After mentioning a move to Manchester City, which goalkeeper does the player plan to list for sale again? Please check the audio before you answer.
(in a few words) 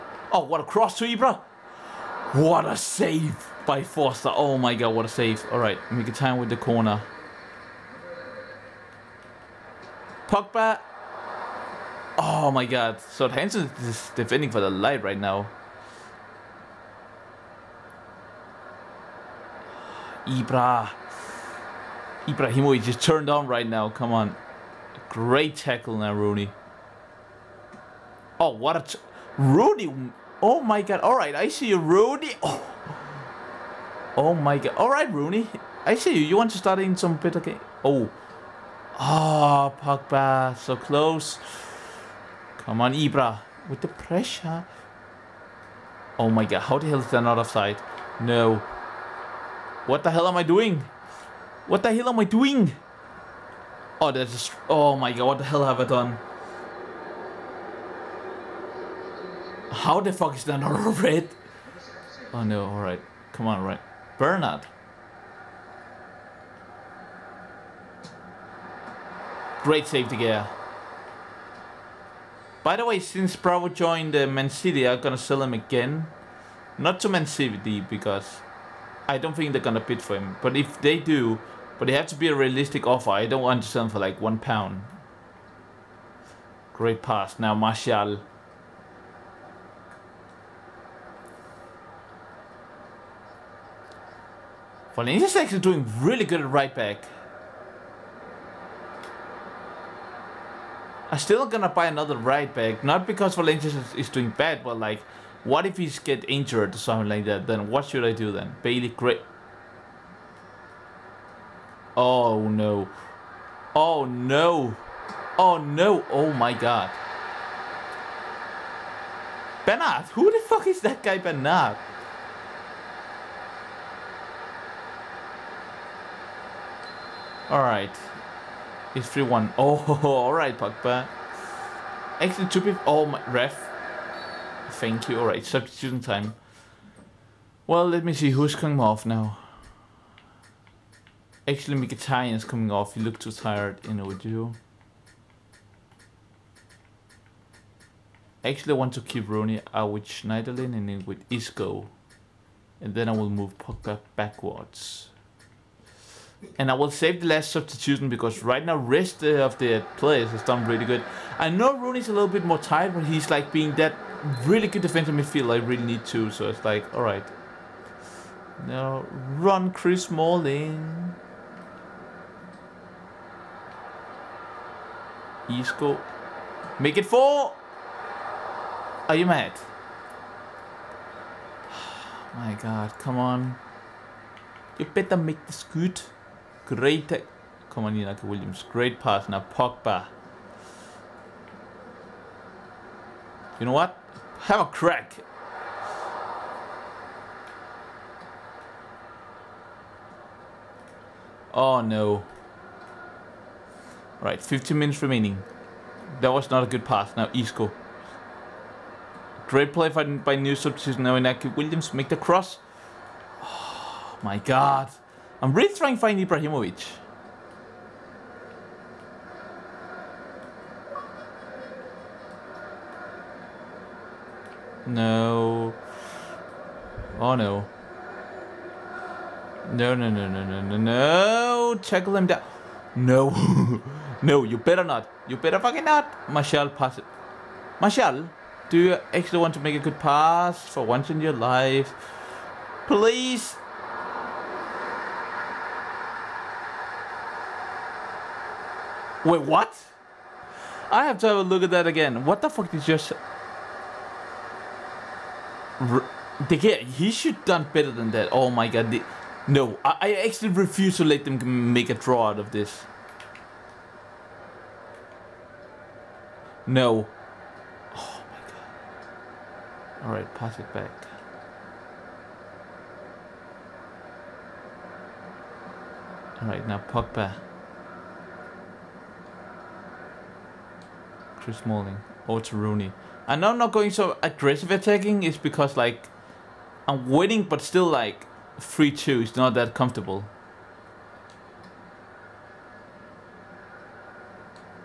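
Bravo.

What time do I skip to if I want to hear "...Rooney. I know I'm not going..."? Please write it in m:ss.
4:42.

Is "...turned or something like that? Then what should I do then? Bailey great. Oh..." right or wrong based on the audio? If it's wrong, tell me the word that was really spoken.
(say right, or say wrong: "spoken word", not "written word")
wrong: "injured", not "turned".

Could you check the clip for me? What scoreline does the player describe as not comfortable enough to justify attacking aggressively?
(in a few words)
3-2.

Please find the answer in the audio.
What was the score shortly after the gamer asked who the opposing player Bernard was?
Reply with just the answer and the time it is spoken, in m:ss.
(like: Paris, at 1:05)
3-1, at 2:09.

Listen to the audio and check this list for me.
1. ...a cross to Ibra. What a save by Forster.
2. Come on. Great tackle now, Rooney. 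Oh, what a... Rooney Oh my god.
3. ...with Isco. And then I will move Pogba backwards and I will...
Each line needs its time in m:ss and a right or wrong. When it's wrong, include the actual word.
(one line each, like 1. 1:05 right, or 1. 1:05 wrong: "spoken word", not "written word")
1. 0:00 right
2. 0:23 right
3. 2:31 right.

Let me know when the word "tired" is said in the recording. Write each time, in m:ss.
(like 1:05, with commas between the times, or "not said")
2:23, 2:42.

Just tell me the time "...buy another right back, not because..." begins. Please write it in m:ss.
1:41.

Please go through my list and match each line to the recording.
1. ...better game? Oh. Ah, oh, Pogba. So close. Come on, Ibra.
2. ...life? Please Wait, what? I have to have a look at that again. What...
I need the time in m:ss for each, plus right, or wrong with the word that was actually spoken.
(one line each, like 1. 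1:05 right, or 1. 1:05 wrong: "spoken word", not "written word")
1. 0:37 right
2. 4:01 right.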